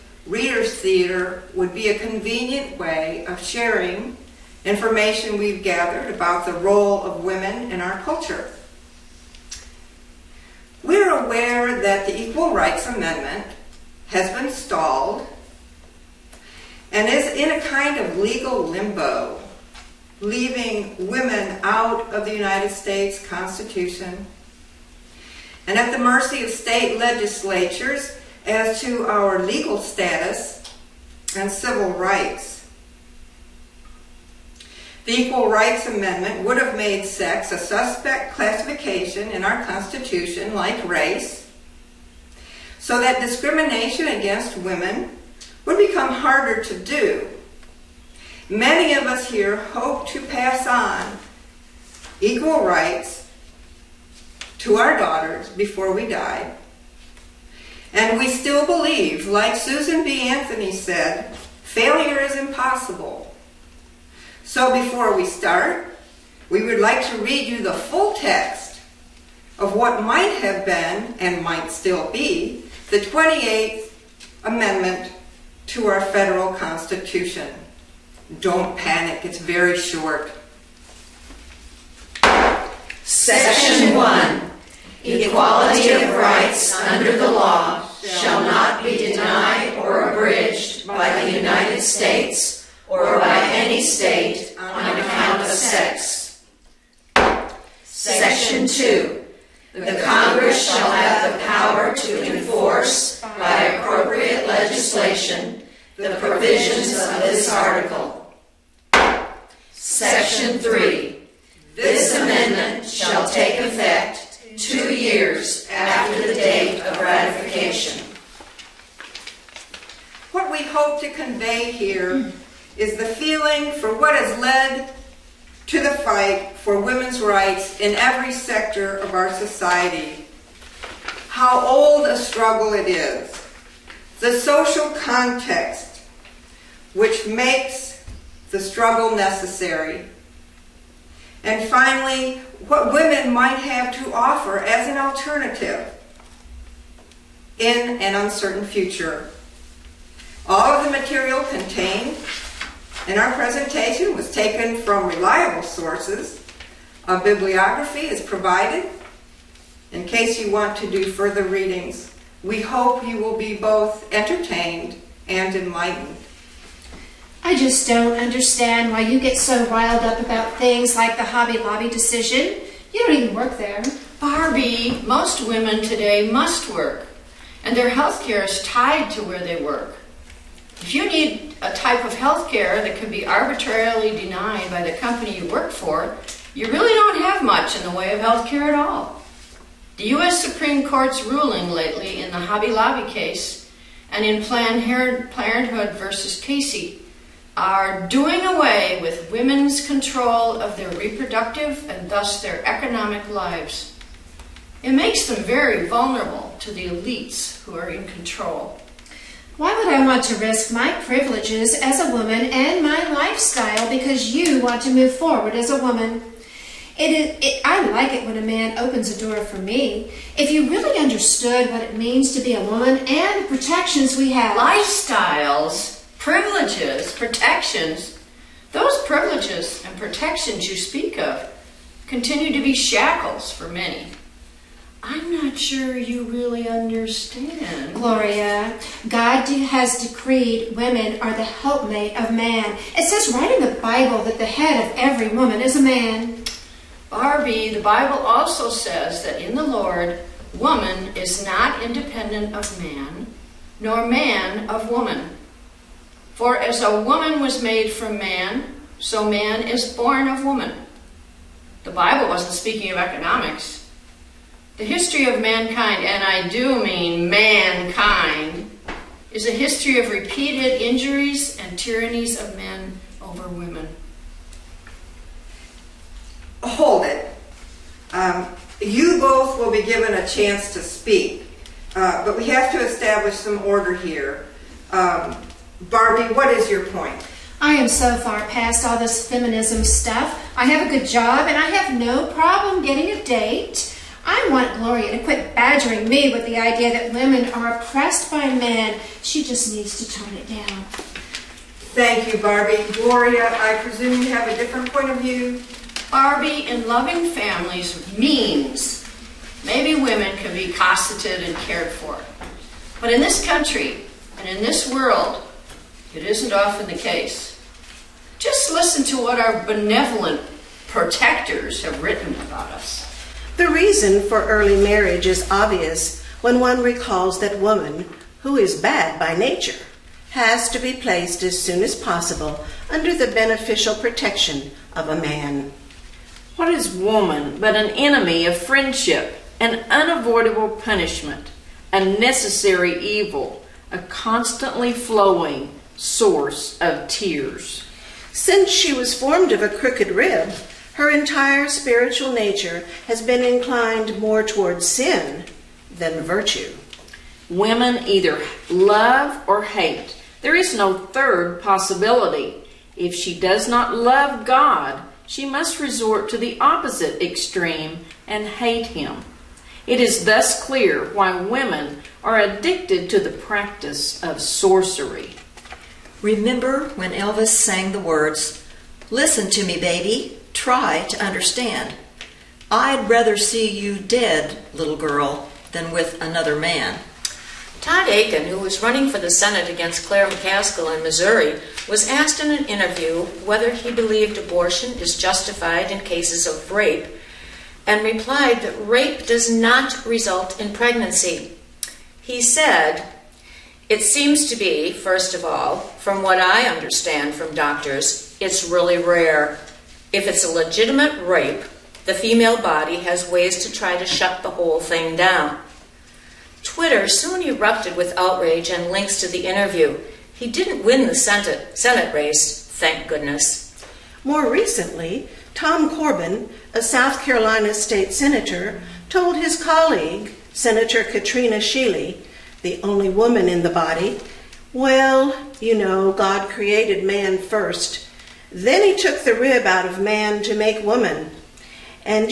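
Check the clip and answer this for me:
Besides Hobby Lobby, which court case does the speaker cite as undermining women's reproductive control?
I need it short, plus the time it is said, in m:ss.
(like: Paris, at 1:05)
Planned Parenthood versus Casey, at 3:14.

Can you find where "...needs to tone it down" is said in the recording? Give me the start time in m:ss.
4:59.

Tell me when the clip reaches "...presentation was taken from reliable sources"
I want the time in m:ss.
2:33.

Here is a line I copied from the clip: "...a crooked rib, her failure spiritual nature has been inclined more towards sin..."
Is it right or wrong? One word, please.
wrong.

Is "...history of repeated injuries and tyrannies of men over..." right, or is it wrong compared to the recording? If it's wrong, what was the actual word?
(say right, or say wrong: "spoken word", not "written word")
right.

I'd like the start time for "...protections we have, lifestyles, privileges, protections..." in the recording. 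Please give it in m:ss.
3:43.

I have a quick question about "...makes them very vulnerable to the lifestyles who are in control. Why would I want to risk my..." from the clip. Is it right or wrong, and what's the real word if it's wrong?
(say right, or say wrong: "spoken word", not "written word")
wrong: "elites", not "lifestyles".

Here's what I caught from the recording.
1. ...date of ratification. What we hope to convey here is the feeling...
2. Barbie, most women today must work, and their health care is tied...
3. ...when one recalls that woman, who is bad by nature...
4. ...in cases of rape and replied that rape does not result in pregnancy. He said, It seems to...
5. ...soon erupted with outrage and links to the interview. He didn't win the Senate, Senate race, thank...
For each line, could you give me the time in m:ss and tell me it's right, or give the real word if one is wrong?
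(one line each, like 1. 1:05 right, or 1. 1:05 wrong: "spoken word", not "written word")
1. 1:56 right
2. 2:54 right
3. 5:26 right
4. 6:35 right
5. 6:57 right.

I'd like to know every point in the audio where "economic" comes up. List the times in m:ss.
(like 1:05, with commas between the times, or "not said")
3:22, 4:22.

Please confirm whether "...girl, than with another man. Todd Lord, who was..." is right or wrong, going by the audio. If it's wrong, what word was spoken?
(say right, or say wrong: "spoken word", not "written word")
wrong: "Akin", not "Lord".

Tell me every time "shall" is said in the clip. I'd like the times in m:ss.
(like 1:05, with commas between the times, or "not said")
1:28, 1:40, 1:52.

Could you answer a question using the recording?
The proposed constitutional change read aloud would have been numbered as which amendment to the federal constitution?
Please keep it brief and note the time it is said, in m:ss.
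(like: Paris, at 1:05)
28th, at 1:12.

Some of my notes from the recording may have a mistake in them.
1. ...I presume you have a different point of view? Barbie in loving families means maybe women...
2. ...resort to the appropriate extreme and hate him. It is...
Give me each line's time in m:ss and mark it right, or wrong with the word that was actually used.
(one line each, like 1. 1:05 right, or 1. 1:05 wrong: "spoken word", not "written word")
1. 5:03 right
2. 6:05 wrong: "opposite", not "appropriate".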